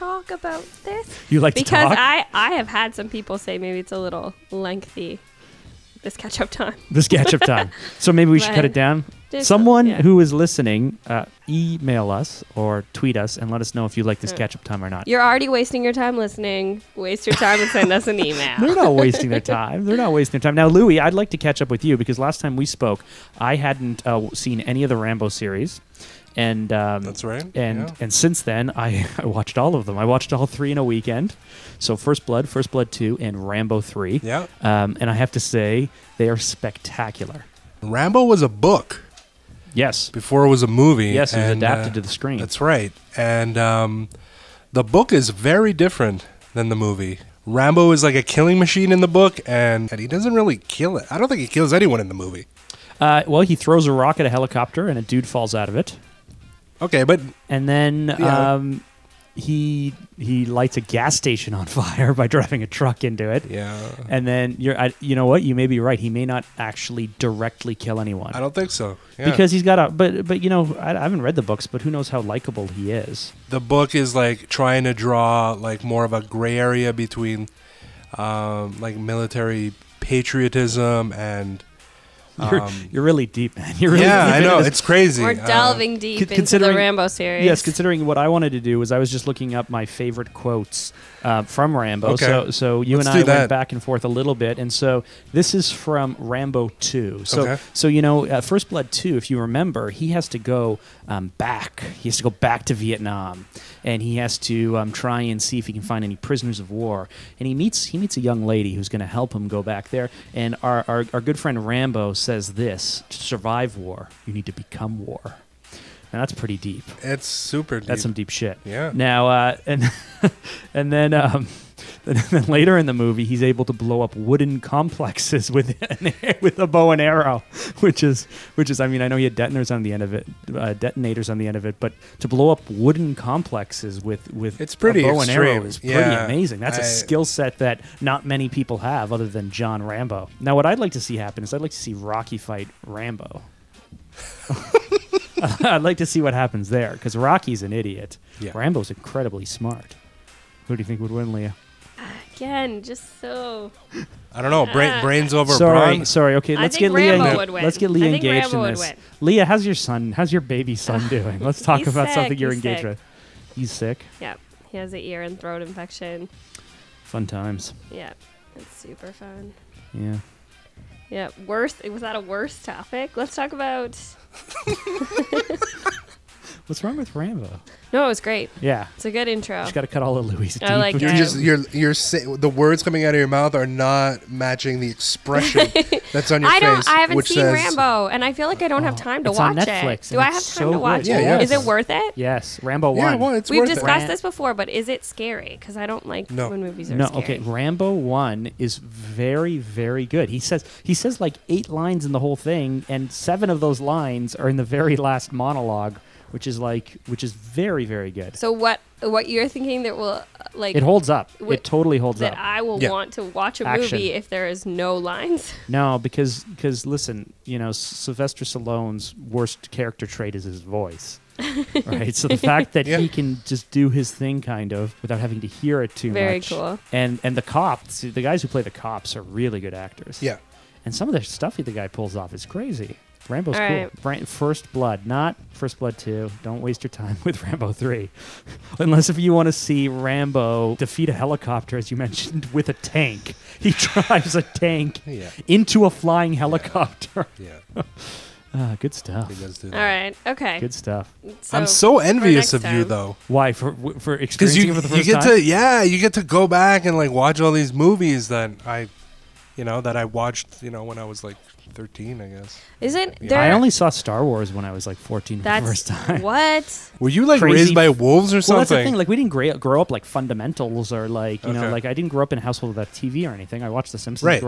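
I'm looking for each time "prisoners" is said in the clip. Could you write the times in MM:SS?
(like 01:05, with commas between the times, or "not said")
01:46.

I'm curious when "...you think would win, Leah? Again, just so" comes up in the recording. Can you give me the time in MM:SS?
02:30.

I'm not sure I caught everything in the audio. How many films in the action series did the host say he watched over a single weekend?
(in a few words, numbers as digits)
3.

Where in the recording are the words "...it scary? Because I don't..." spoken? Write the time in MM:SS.
03:14.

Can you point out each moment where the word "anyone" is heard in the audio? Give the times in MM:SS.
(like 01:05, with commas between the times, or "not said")
00:51, 01:07.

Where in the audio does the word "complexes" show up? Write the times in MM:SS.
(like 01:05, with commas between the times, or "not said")
02:04, 02:13.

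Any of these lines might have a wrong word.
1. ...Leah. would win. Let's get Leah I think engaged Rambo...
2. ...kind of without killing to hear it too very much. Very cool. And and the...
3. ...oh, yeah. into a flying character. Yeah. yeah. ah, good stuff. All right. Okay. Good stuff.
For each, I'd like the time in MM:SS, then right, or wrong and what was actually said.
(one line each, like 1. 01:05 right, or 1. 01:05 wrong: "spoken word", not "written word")
1. 02:37 right
2. 03:44 wrong: "having", not "killing"
3. 04:05 wrong: "helicopter", not "character".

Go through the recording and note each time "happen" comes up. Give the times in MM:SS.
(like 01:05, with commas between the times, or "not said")
02:21, 02:26.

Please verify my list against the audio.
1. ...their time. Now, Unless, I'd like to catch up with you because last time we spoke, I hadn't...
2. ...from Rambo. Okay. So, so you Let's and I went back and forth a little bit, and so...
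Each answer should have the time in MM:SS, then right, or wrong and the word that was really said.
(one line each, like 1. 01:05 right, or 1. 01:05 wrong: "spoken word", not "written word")
1. 00:20 wrong: "Louie", not "Unless"
2. 01:31 right.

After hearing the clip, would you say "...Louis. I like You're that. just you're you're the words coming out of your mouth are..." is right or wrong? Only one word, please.
right.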